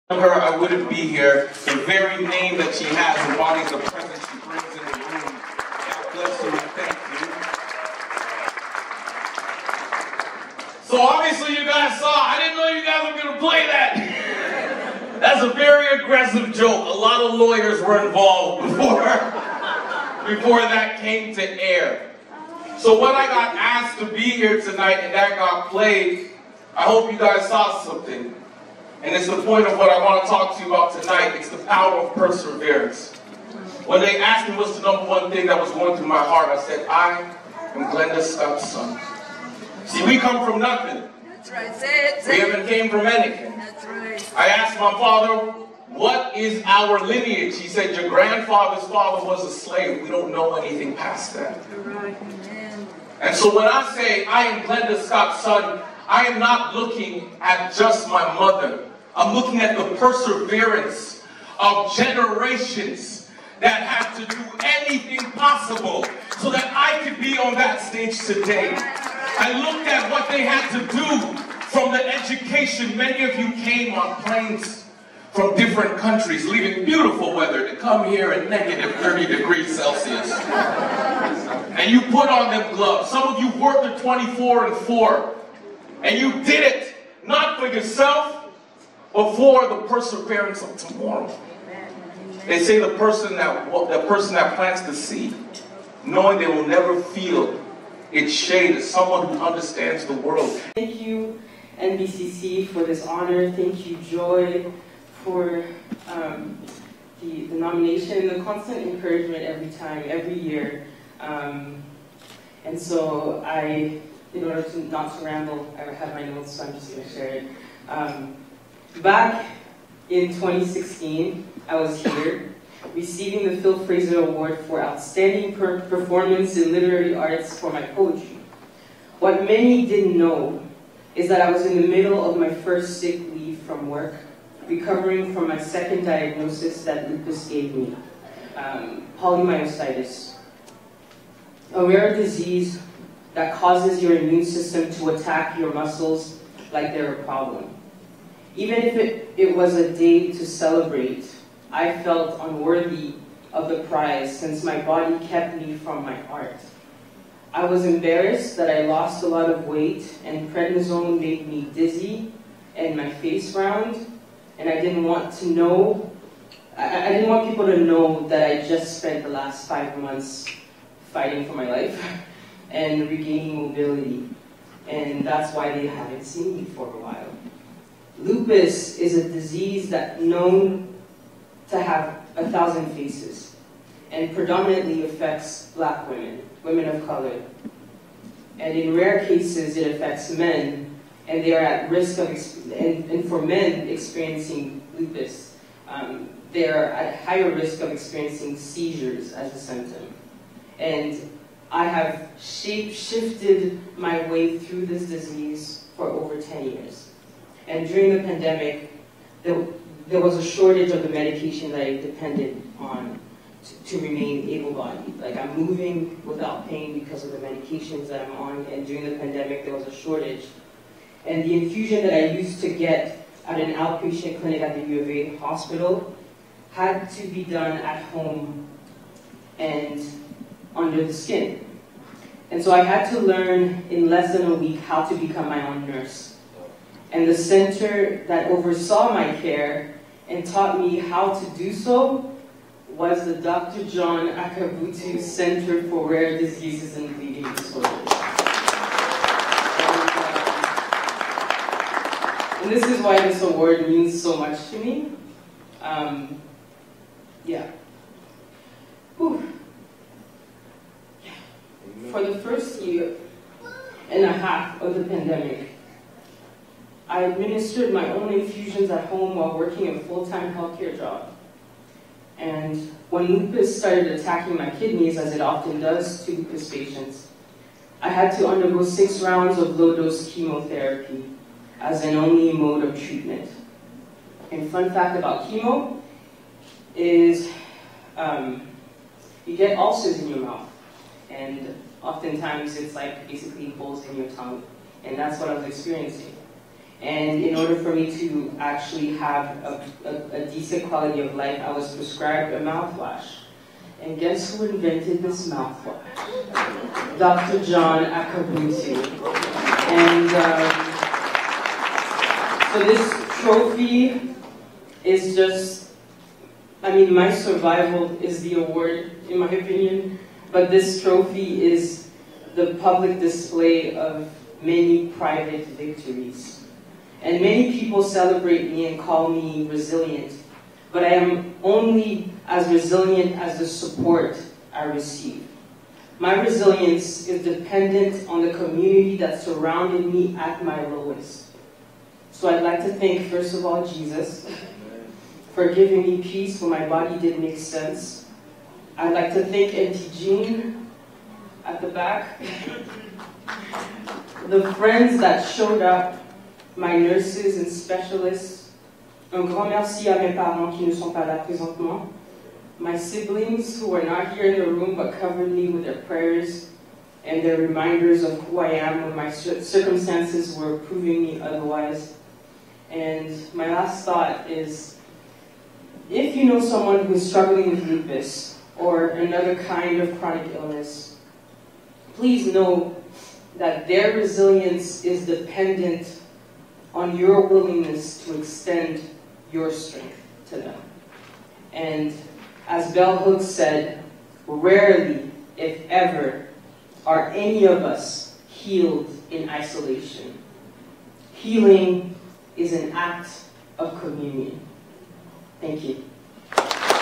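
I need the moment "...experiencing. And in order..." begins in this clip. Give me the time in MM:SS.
04:55.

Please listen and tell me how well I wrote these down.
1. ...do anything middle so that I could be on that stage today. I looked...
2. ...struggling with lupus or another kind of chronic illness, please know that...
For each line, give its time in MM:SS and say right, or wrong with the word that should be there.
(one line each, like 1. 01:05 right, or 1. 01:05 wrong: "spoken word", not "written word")
1. 01:04 wrong: "possible", not "middle"
2. 06:17 right.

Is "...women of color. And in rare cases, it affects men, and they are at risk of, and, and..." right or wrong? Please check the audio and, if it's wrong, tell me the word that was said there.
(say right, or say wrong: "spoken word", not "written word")
right.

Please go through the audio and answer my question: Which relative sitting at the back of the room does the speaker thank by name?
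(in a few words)
Auntie Jean.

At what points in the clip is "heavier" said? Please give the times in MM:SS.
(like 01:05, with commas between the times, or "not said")
not said.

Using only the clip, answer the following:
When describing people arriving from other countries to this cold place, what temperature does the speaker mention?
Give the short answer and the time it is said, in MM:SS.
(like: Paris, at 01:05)
-30 degrees Celsius, at 01:18.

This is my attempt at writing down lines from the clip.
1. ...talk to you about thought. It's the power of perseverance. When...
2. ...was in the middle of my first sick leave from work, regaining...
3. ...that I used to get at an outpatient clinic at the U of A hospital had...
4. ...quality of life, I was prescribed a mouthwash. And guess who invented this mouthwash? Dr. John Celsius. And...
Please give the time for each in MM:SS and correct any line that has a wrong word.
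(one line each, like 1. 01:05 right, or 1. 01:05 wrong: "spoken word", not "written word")
1. 00:30 wrong: "tonight", not "thought"
2. 02:11 wrong: "recovering", not "regaining"
3. 03:42 right
4. 05:00 wrong: "Akabutu", not "Celsius".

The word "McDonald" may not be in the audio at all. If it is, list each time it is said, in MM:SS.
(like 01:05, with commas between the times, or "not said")
not said.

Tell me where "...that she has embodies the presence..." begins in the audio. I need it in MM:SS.
00:02.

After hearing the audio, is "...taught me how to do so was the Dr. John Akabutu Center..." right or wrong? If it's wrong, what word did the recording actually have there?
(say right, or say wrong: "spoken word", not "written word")
right.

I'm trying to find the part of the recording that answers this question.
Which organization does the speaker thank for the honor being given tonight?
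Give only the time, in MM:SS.
01:41.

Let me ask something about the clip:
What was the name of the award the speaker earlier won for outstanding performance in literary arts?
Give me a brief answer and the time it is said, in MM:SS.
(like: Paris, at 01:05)
Phil Fraser Award, at 02:03.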